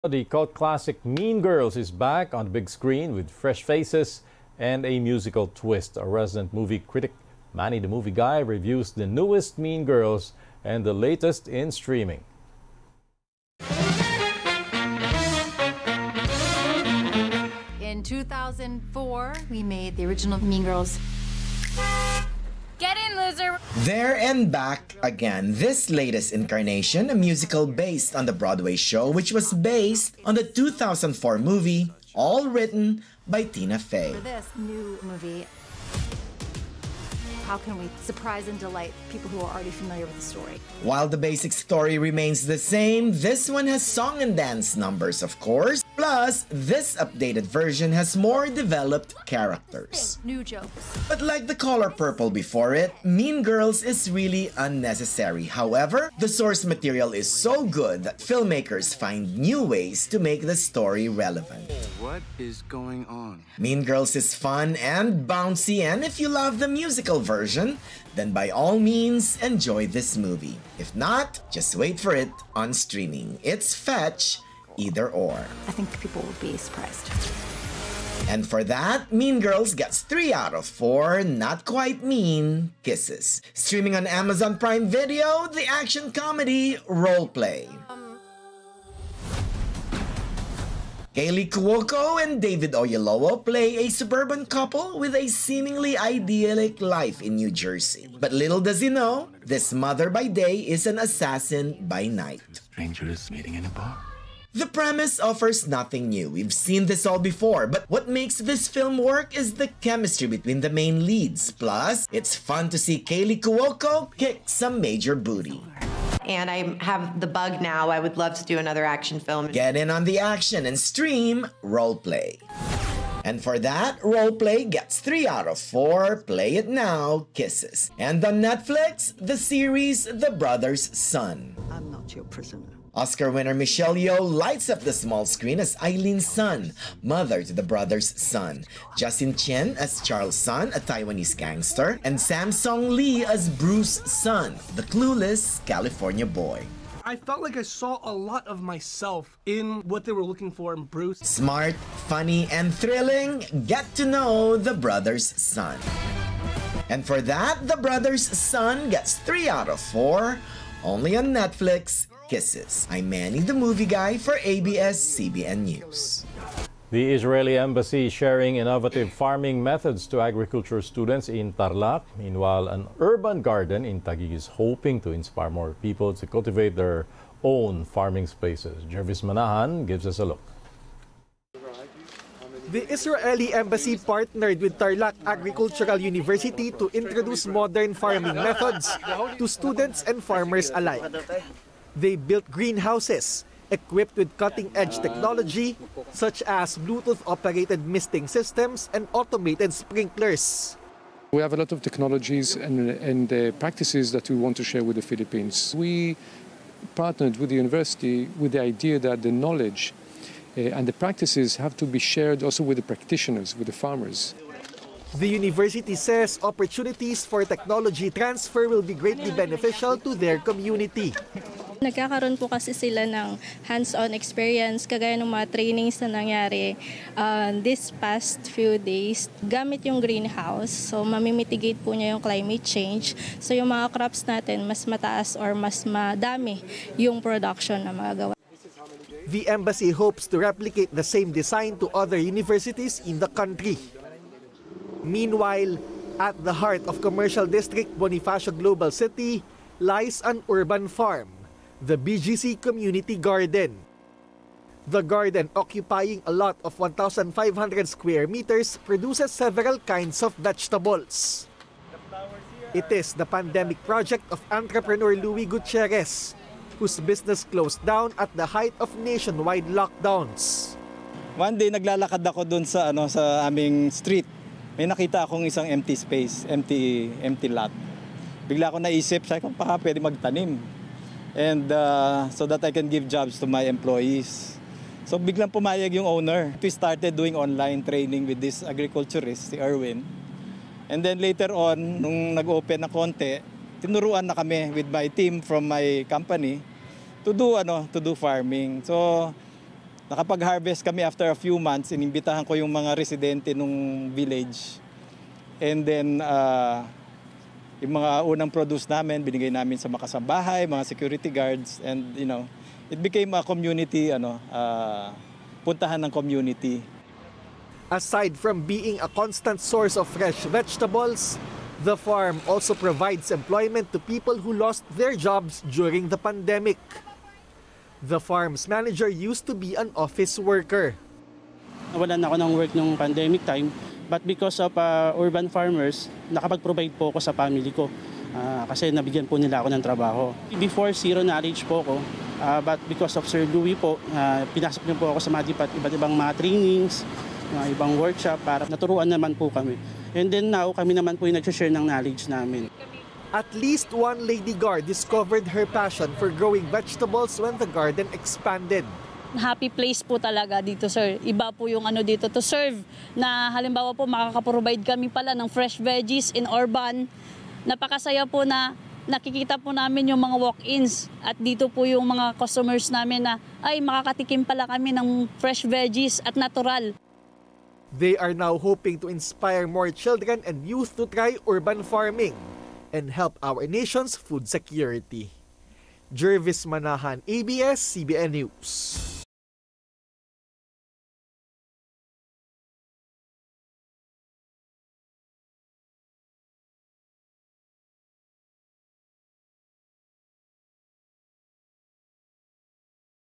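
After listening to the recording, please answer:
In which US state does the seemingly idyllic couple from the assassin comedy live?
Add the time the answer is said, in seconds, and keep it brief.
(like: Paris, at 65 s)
New Jersey, at 97 s.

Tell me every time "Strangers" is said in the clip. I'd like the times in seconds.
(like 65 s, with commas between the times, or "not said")
102 s.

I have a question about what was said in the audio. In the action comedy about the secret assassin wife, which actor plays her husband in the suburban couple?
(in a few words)
David Oyelowo.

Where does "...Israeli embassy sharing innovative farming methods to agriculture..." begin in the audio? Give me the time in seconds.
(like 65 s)
167 s.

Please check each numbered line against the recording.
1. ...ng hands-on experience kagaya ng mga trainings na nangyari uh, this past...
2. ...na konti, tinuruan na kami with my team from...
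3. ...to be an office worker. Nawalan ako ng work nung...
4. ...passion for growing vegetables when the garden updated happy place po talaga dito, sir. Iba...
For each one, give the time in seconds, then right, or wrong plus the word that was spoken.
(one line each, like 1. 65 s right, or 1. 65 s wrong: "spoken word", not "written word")
1. 223 s right
2. 292 s right
3. 329 s right
4. 355 s wrong: "expanded", not "updated".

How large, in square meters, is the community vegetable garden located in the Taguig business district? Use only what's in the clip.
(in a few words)
1,500 square meters.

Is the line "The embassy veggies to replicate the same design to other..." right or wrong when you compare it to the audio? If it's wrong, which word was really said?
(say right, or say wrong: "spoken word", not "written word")
wrong: "hopes", not "veggies".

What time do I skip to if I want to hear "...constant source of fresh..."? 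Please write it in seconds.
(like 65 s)
319 s.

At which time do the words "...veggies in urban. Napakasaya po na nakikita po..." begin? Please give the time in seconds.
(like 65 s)
365 s.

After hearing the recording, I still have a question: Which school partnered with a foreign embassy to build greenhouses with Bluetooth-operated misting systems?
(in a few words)
Tarlac Agricultural University.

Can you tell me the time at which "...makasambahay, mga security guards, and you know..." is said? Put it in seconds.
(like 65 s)
309 s.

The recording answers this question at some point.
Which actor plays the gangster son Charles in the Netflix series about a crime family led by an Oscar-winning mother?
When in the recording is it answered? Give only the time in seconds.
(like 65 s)
138 s.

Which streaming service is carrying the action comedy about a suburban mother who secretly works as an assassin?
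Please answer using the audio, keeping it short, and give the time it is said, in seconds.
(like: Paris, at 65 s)
Amazon Prime Video, at 84 s.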